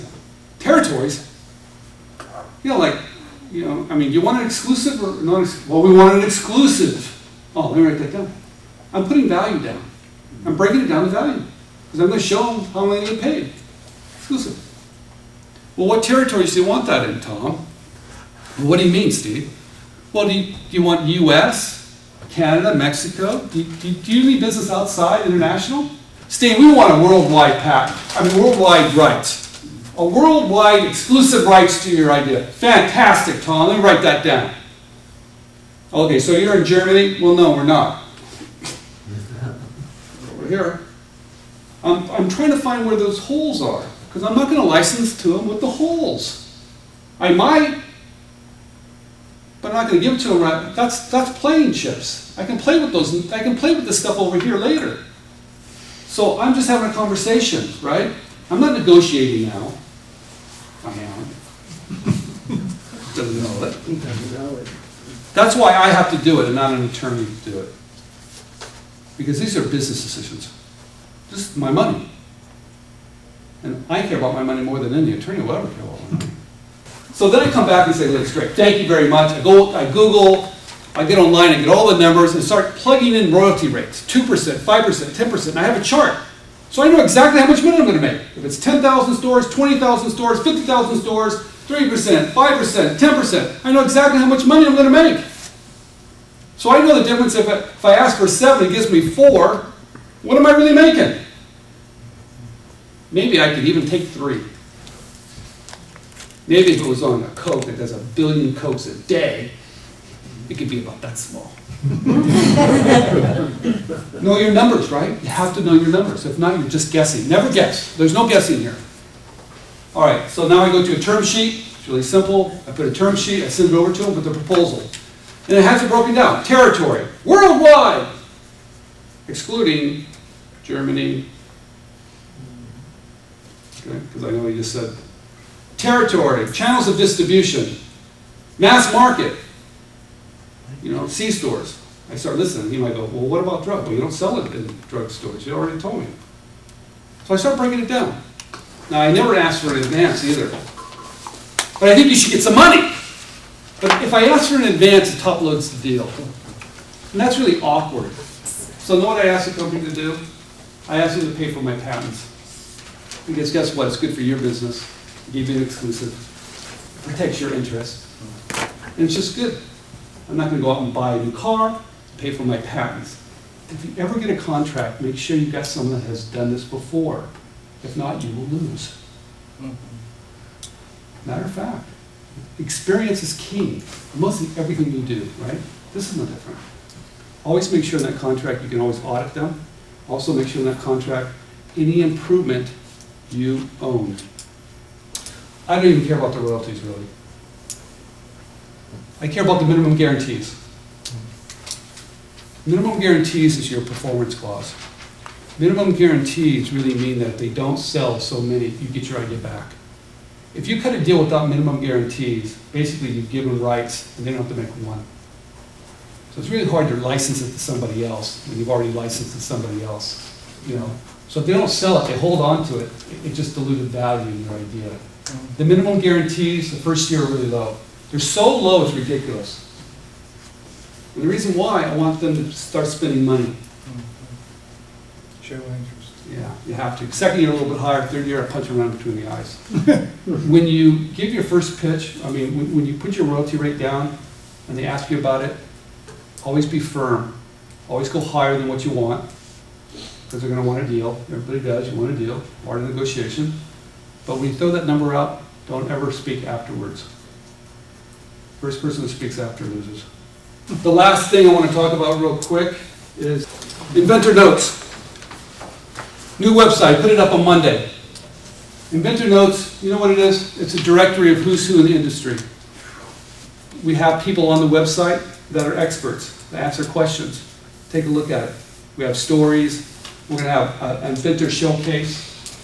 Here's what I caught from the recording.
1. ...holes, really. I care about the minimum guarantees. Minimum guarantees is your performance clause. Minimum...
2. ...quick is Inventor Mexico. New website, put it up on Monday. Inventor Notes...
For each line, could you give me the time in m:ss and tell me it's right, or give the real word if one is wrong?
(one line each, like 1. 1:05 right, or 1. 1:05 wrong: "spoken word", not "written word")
1. 3:16 wrong: "royalties", not "holes"
2. 4:22 wrong: "Notes", not "Mexico".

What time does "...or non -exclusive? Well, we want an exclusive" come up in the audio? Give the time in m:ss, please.
0:05.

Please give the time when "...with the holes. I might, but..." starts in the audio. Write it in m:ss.
0:45.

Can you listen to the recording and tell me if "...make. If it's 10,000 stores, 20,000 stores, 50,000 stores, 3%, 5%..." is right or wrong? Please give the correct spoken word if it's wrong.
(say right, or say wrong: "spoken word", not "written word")
right.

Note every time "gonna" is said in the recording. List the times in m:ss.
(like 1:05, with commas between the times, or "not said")
1:27, 1:34.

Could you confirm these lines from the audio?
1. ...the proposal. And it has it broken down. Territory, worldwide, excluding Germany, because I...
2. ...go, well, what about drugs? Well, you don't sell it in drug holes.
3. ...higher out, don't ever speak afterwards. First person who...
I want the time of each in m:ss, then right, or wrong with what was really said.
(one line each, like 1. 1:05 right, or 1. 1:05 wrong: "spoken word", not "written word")
1. 2:04 right
2. 2:22 wrong: "stores", not "holes"
3. 4:14 wrong: "number", not "higher".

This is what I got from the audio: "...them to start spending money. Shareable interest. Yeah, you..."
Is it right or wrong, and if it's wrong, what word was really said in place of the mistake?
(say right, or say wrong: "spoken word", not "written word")
right.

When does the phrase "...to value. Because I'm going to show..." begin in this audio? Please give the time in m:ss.
0:11.